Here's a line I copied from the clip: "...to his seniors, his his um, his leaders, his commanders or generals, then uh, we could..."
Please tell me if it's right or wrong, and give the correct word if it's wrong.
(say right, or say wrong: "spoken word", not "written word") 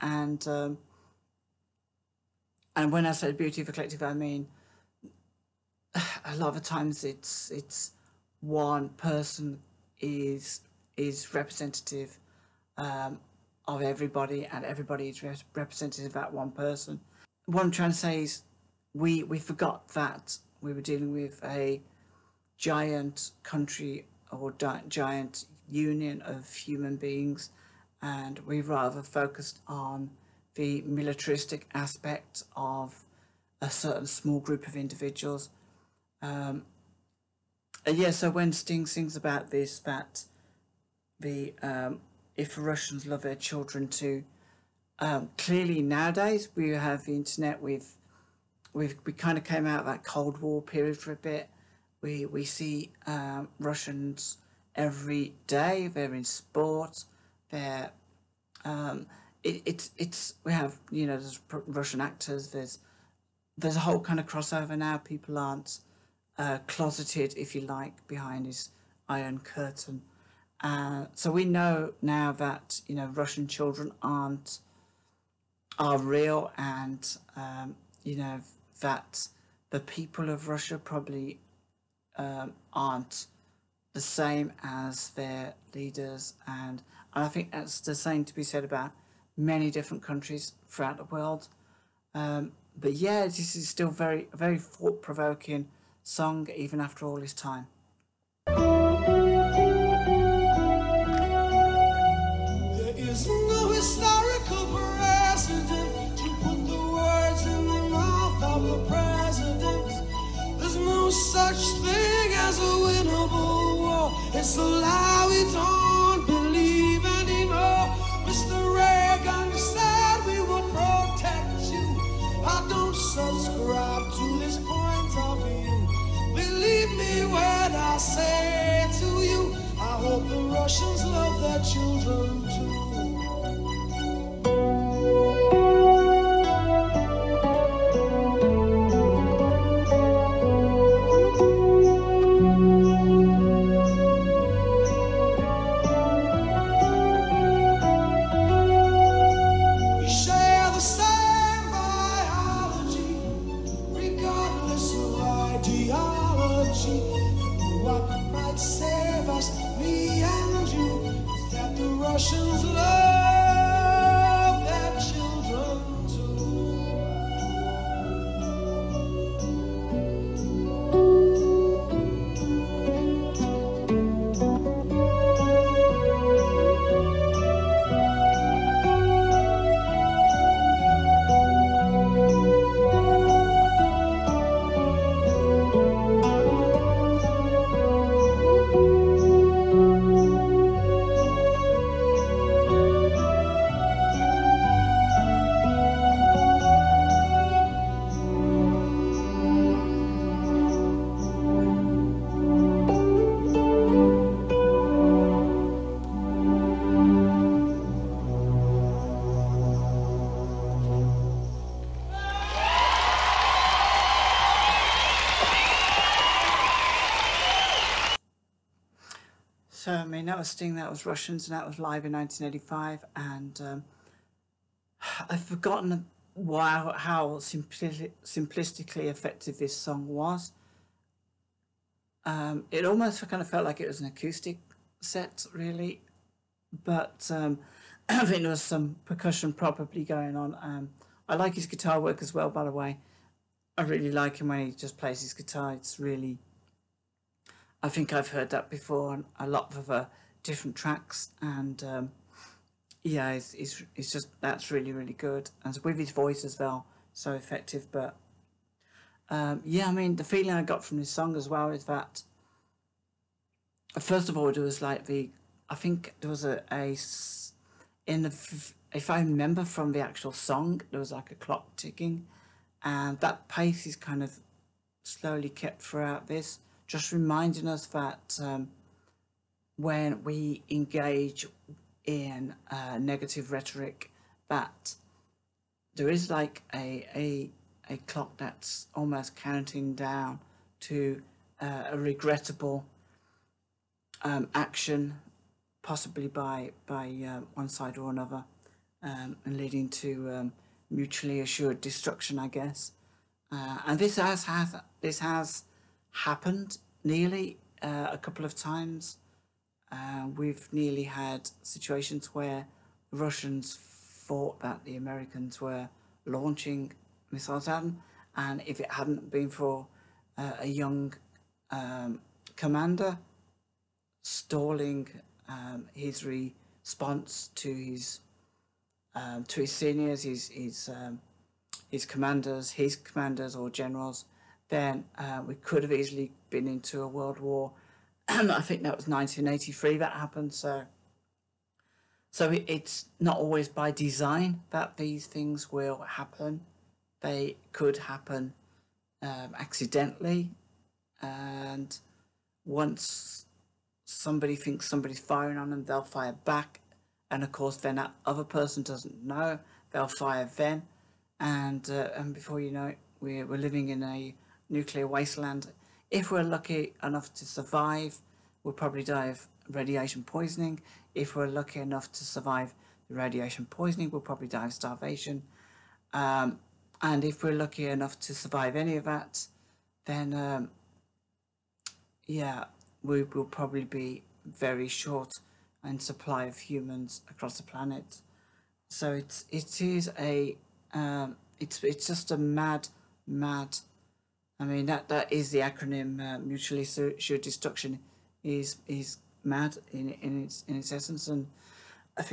wrong: "commanders", not "leaders".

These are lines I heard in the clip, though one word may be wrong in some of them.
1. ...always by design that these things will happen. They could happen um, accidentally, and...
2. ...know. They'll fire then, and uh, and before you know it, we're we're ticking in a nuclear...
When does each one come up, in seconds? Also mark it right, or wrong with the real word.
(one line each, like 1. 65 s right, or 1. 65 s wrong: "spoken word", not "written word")
1. 343 s right
2. 359 s wrong: "living", not "ticking".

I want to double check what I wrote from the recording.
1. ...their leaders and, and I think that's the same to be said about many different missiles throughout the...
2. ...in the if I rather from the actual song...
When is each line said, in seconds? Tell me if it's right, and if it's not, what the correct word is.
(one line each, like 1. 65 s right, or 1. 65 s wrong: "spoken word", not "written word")
1. 85 s wrong: "countries", not "missiles"
2. 268 s wrong: "remember", not "rather".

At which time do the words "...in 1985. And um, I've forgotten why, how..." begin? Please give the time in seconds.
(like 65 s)
222 s.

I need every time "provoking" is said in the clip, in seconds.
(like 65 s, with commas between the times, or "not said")
95 s.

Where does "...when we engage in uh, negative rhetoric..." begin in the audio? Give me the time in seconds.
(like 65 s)
279 s.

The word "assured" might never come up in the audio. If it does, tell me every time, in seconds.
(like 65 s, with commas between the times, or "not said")
301 s, 396 s.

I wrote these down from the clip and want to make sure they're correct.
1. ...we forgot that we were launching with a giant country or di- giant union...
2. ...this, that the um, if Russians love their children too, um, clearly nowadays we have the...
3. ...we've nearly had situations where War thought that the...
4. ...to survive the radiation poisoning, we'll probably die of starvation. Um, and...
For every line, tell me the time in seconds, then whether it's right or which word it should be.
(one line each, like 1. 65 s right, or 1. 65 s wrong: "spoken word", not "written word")
1. 19 s wrong: "dealing", not "launching"
2. 39 s right
3. 310 s wrong: "Russians", not "War"
4. 372 s right.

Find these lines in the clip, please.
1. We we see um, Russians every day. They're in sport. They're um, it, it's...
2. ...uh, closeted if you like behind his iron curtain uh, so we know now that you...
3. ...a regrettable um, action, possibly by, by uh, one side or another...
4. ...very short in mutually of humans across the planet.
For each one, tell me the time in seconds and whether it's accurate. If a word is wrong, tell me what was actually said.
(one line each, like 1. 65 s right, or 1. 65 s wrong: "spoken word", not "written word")
1. 52 s right
2. 66 s right
3. 291 s right
4. 384 s wrong: "supply", not "mutually".